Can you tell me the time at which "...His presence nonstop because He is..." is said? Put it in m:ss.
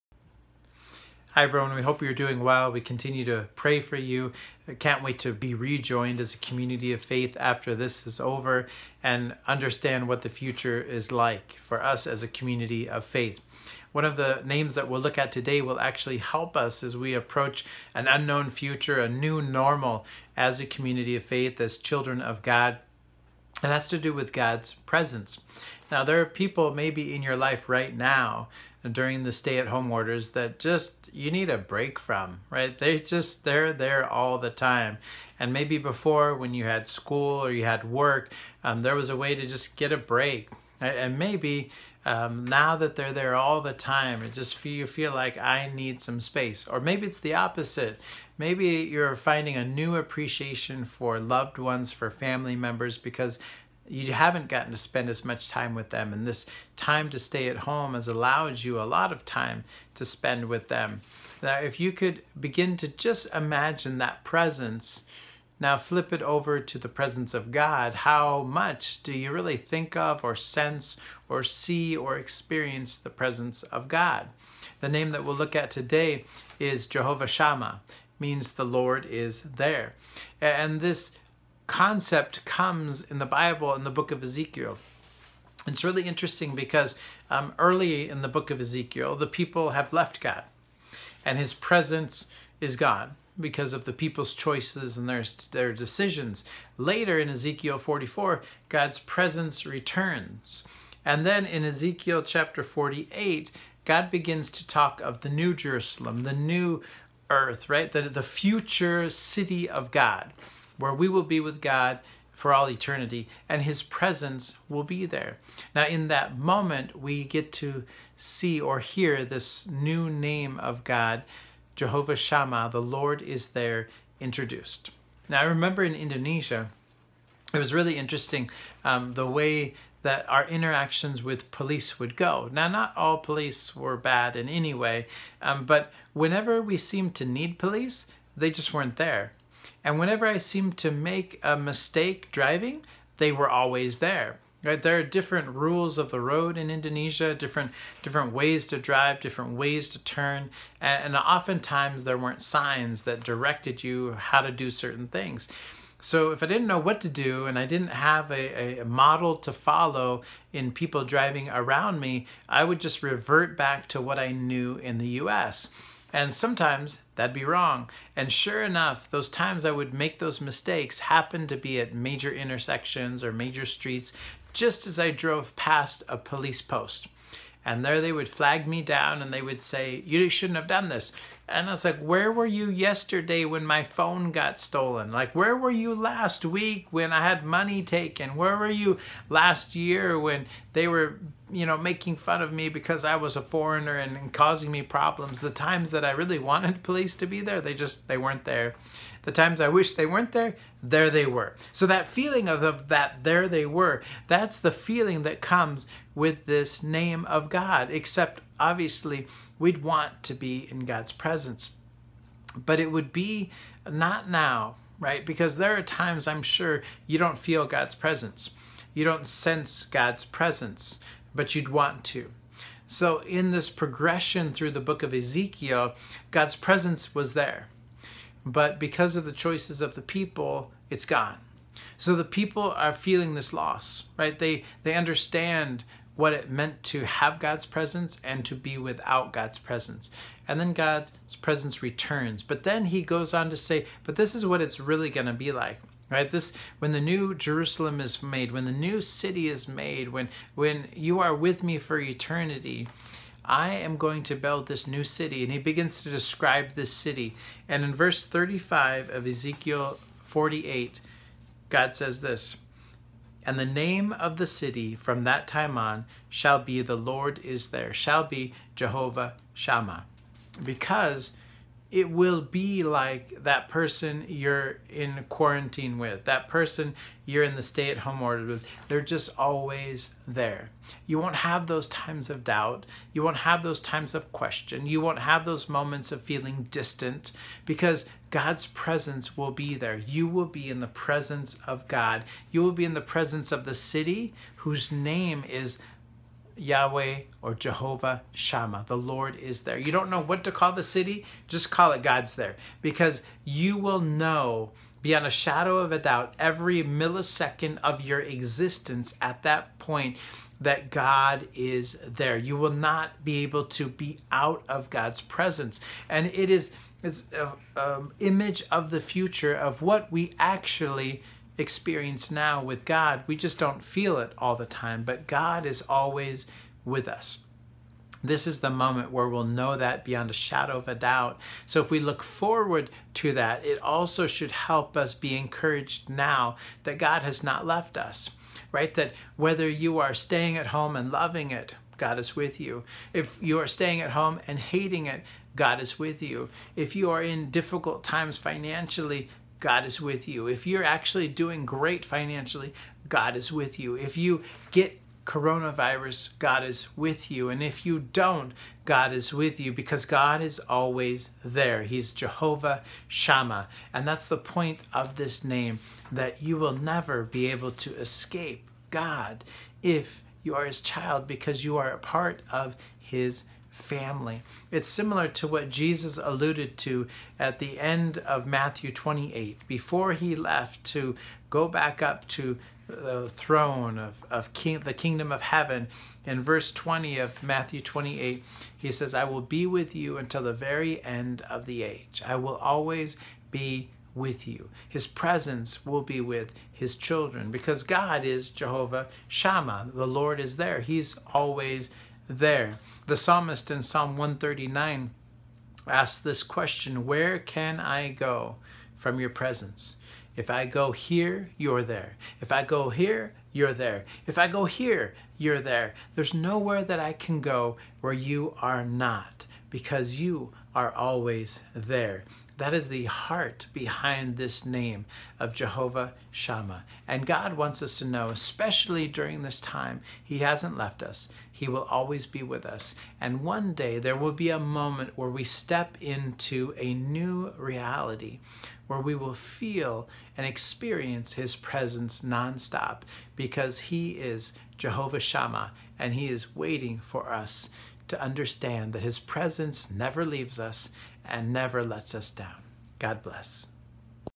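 7:21.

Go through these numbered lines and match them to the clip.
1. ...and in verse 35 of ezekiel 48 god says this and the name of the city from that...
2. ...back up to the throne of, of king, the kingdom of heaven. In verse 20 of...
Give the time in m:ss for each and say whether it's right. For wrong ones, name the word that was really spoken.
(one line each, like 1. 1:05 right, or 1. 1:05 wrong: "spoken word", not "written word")
1. 4:17 right
2. 6:21 right.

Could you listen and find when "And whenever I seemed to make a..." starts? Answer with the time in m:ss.
2:19.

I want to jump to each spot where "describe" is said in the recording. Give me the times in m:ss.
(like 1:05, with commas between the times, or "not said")
4:16.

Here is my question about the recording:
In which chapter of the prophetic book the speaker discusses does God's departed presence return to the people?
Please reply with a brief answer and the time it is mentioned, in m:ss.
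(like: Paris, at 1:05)
44, at 1:37.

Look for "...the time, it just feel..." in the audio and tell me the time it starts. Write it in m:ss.
0:43.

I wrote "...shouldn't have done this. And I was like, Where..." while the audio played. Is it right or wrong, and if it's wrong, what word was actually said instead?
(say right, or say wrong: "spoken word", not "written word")
right.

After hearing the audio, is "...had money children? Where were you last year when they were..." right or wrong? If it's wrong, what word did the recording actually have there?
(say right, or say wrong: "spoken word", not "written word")
wrong: "taken", not "children".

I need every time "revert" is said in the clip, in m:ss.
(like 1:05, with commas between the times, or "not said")
2:43.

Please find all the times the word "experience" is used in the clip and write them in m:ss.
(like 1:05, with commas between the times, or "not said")
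1:12, 5:21, 7:20.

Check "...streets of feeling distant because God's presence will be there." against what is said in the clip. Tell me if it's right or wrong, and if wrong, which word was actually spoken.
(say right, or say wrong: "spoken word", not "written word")
wrong: "moments", not "streets".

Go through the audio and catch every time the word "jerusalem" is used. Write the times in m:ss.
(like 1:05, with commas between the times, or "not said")
1:45, 4:07.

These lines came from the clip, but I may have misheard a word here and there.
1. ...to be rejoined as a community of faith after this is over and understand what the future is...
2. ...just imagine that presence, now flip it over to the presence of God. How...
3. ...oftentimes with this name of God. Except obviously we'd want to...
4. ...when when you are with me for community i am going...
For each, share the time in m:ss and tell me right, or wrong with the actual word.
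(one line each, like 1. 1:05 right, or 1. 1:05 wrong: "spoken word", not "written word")
1. 0:05 right
2. 1:02 right
3. 3:25 wrong: "comes", not "oftentimes"
4. 4:10 wrong: "eternity", not "community".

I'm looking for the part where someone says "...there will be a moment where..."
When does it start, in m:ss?
7:13.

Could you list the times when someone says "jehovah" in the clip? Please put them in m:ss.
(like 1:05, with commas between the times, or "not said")
1:16, 2:01, 4:28, 4:57, 6:02, 6:38, 7:05, 7:24.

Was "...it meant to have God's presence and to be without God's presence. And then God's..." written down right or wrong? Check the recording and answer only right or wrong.
right.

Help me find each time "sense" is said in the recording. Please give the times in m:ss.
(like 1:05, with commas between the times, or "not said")
1:10, 3:39.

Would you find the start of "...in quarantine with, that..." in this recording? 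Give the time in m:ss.
4:34.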